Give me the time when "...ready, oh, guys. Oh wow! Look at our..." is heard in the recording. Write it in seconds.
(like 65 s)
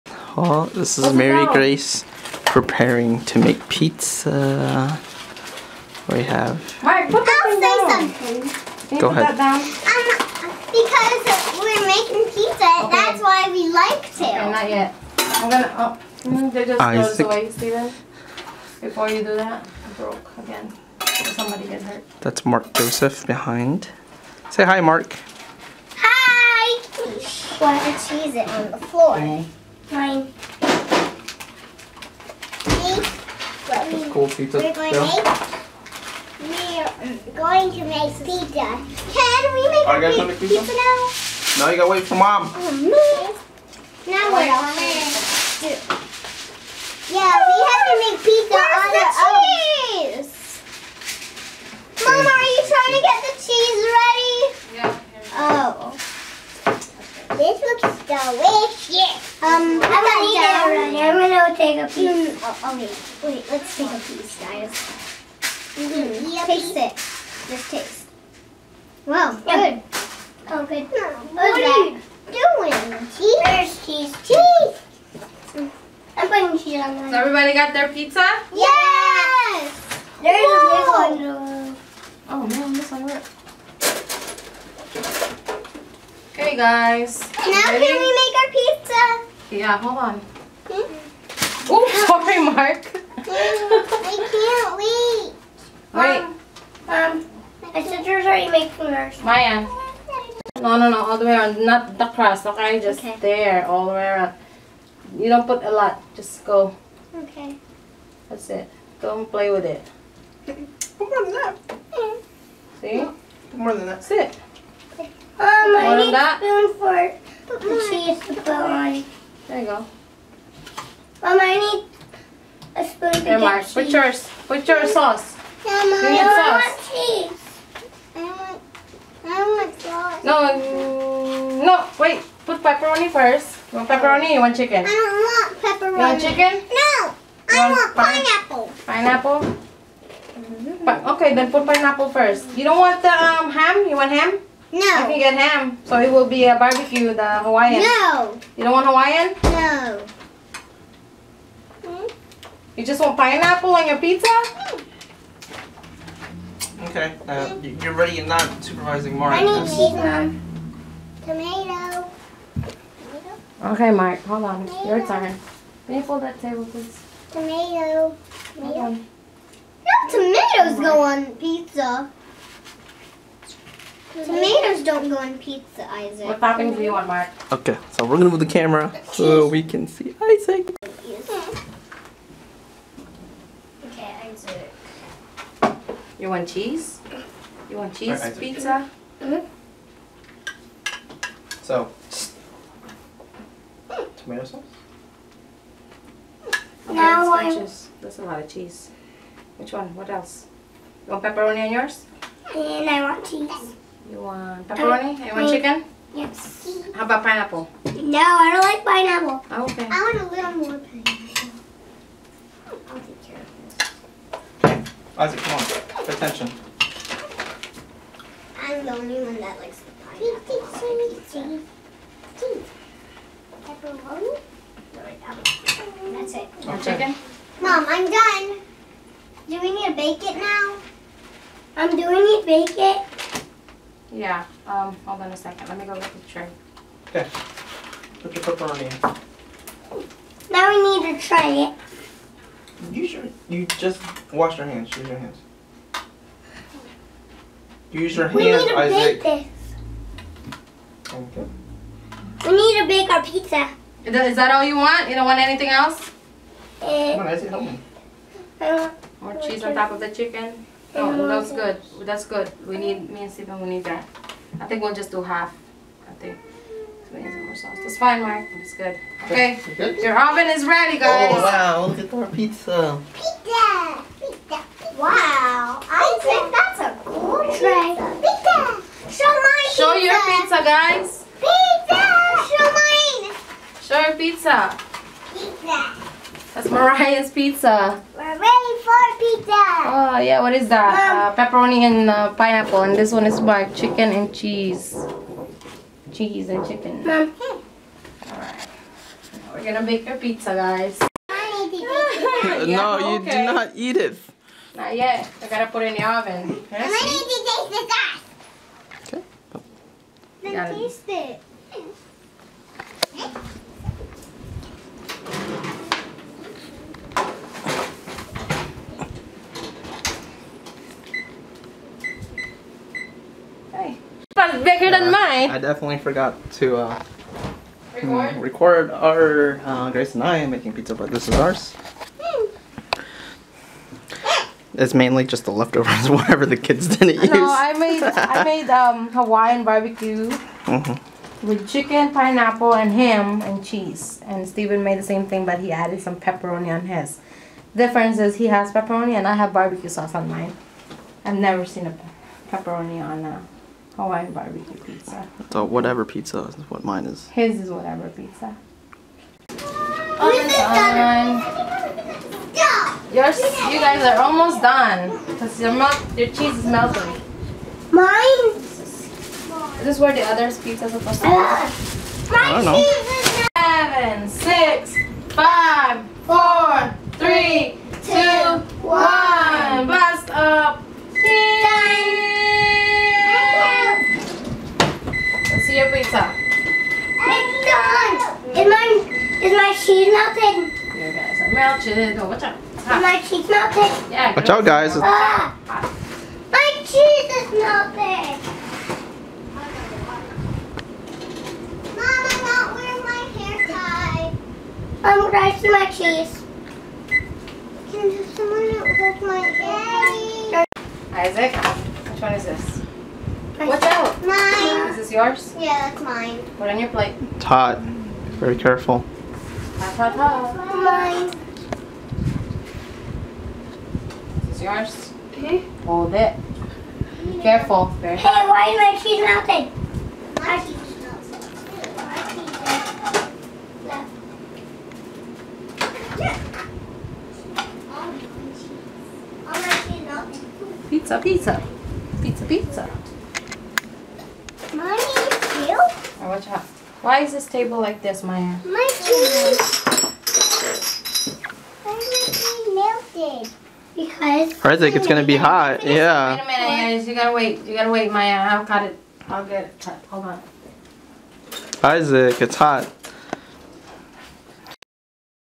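270 s.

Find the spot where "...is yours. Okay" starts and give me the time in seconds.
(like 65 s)
424 s.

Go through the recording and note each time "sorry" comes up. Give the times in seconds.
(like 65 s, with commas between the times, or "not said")
92 s.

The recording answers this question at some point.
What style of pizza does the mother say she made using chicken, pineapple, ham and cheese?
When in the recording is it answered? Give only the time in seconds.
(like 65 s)
339 s.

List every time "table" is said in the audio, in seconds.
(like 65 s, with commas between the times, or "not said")
166 s, 447 s.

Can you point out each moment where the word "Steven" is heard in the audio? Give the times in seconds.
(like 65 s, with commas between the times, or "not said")
263 s, 344 s.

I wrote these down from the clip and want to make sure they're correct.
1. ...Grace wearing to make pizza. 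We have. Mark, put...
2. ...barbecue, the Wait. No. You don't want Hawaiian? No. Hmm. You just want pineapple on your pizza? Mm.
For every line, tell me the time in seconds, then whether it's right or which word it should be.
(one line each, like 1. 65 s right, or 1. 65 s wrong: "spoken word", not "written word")
1. 1 s wrong: "preparing", not "wearing"
2. 146 s wrong: "Hawaiian", not "Wait".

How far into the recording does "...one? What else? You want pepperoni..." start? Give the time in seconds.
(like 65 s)
199 s.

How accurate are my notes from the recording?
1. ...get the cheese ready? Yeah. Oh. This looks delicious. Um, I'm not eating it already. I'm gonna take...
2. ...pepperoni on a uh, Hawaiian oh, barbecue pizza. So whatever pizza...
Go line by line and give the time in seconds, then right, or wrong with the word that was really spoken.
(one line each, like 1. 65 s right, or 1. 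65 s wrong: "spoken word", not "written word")
1. 56 s right
2. 352 s right.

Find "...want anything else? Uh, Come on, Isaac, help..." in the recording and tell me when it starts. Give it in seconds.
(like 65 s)
255 s.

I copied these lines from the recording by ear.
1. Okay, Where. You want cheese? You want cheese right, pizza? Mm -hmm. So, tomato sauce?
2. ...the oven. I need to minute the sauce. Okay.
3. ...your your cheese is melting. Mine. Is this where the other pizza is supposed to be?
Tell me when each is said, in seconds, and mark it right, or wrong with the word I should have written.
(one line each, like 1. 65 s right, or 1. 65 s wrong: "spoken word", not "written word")
1. 183 s wrong: "Isaac", not "Where"
2. 305 s wrong: "taste", not "minute"
3. 365 s right.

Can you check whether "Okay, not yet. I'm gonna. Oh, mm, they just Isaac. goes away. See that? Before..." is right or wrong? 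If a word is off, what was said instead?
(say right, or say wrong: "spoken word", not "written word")
right.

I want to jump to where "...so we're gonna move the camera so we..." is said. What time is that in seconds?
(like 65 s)
177 s.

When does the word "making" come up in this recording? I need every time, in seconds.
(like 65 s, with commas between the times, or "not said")
11 s, 98 s, 330 s.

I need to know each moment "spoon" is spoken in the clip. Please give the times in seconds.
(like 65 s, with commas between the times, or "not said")
116 s, 122 s.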